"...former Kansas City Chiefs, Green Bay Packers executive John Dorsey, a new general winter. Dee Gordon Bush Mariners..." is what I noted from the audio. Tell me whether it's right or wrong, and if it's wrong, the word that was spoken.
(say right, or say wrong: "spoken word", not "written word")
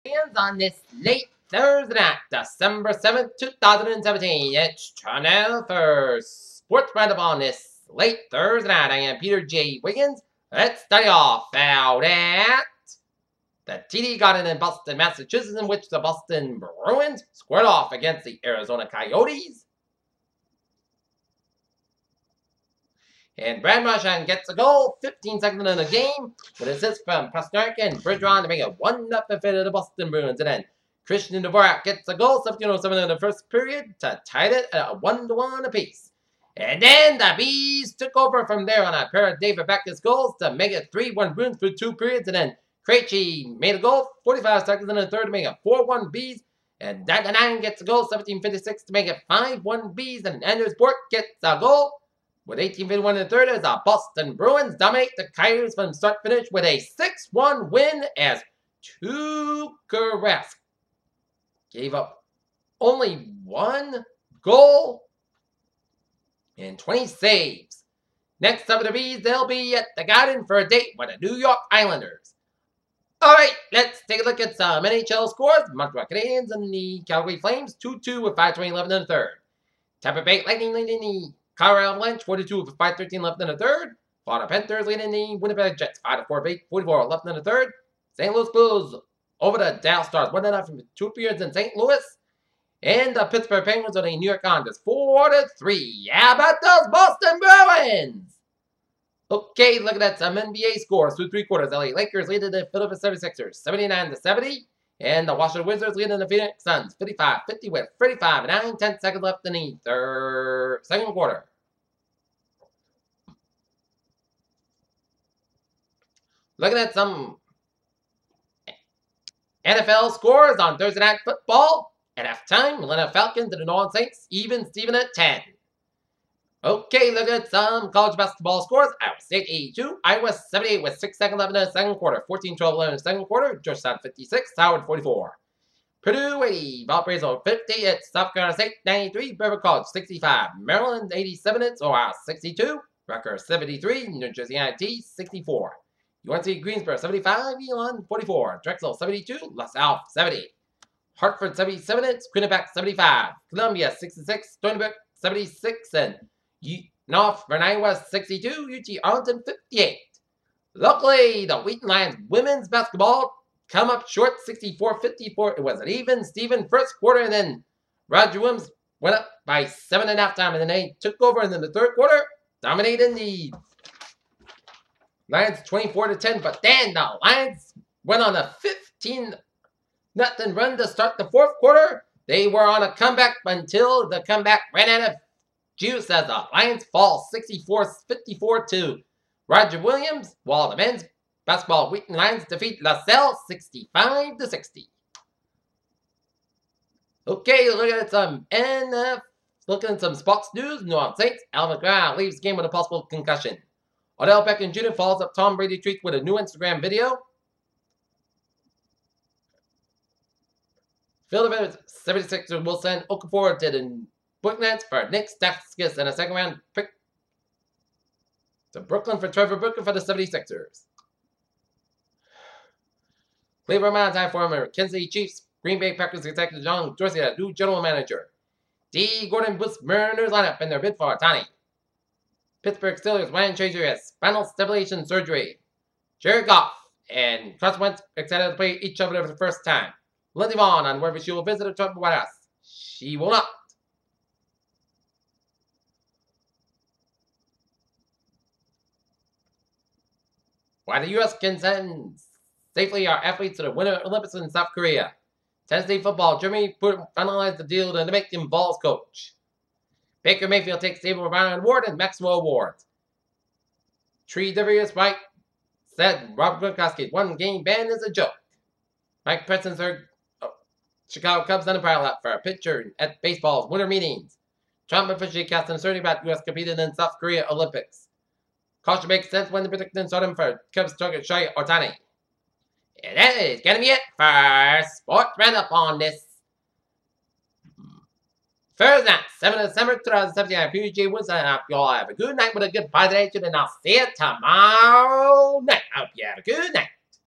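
wrong: "manager", not "winter".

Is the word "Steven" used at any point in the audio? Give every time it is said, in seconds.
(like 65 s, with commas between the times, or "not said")
124 s, 166 s.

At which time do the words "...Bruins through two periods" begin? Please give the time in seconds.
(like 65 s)
41 s.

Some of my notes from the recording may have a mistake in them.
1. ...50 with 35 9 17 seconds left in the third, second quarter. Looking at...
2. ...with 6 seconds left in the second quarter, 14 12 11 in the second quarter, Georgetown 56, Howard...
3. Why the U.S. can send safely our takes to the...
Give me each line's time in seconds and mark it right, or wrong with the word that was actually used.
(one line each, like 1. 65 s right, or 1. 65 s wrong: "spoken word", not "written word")
1. 107 s wrong: "10", not "17"
2. 130 s right
3. 250 s wrong: "athletes", not "takes".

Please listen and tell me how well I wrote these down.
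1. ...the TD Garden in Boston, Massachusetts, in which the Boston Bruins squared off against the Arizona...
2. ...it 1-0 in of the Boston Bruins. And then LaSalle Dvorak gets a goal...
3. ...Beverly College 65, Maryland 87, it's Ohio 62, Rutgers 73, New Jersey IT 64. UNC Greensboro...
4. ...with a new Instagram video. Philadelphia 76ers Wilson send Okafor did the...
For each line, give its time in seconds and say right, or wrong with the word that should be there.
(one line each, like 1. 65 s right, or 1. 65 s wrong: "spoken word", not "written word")
1. 13 s right
2. 28 s wrong: "Christian", not "LaSalle"
3. 139 s right
4. 206 s right.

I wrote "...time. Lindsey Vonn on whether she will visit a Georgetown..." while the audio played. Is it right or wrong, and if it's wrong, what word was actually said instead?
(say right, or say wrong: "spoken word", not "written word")
wrong: "Trump", not "Georgetown".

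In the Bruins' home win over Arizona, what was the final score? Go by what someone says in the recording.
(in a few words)
6-1.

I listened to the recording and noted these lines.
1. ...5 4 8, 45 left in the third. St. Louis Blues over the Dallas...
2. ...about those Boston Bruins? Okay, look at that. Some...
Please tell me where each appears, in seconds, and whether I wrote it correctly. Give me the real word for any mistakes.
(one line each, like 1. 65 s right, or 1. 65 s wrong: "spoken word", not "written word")
1. 85 s wrong: "44", not "45"
2. 96 s right.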